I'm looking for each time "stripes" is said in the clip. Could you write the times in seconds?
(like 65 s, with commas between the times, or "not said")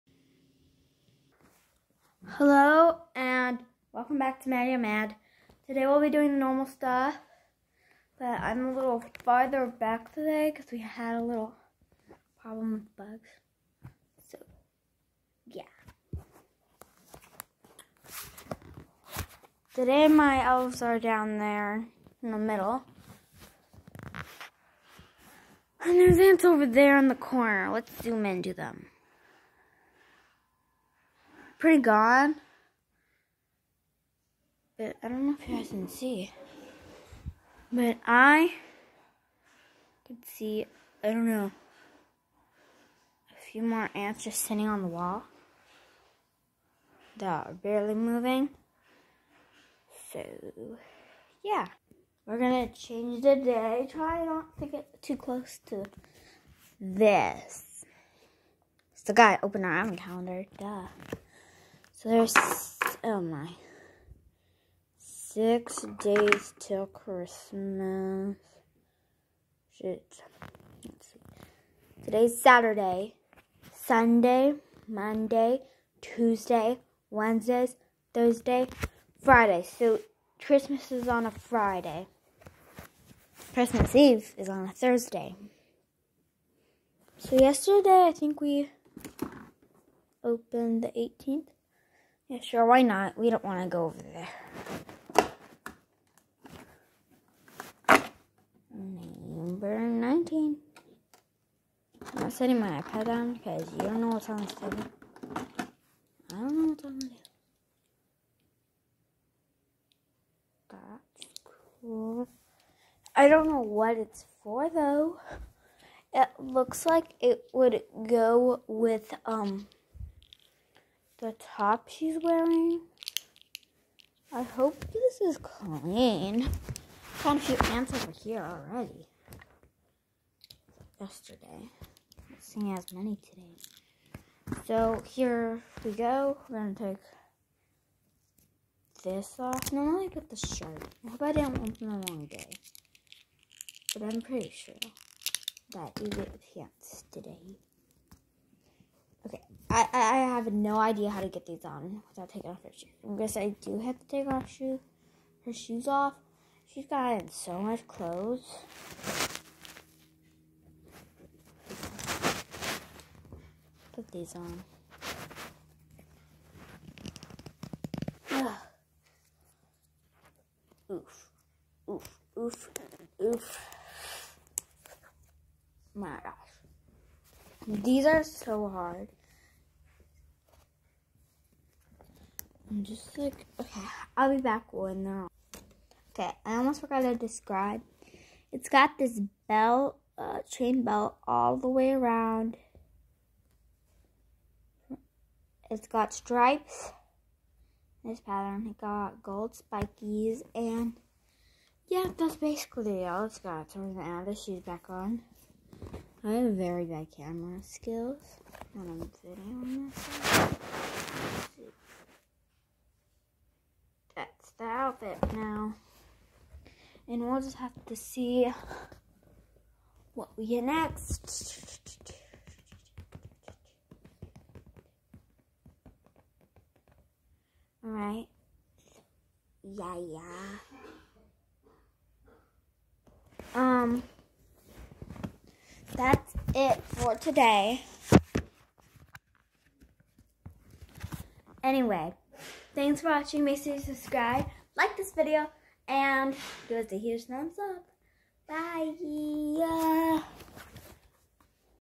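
196 s.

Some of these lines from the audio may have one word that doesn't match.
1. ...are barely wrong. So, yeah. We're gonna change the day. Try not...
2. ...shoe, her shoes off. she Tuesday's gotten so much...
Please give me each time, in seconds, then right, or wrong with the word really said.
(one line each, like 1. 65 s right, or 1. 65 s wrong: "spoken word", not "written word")
1. 47 s wrong: "moving", not "wrong"
2. 154 s wrong: "She", not "Tuesday".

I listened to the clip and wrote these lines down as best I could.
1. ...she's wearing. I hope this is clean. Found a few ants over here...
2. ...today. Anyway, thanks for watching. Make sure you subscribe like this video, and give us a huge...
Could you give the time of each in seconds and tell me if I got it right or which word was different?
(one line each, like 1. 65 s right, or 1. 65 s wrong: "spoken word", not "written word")
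1. 121 s right
2. 237 s right.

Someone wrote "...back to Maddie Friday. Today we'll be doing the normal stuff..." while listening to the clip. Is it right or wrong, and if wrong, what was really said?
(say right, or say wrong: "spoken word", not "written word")
wrong: "Mad", not "Friday".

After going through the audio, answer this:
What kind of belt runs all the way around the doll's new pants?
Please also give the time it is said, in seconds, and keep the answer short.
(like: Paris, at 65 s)
Chain belt, at 190 s.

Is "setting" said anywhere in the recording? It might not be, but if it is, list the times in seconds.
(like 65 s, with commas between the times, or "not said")
102 s.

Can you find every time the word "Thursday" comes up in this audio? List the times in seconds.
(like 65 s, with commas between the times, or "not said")
78 s, 84 s.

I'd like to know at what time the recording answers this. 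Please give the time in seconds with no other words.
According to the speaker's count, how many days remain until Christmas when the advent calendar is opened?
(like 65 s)
64 s.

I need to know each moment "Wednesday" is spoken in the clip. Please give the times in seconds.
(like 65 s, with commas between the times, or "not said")
77 s.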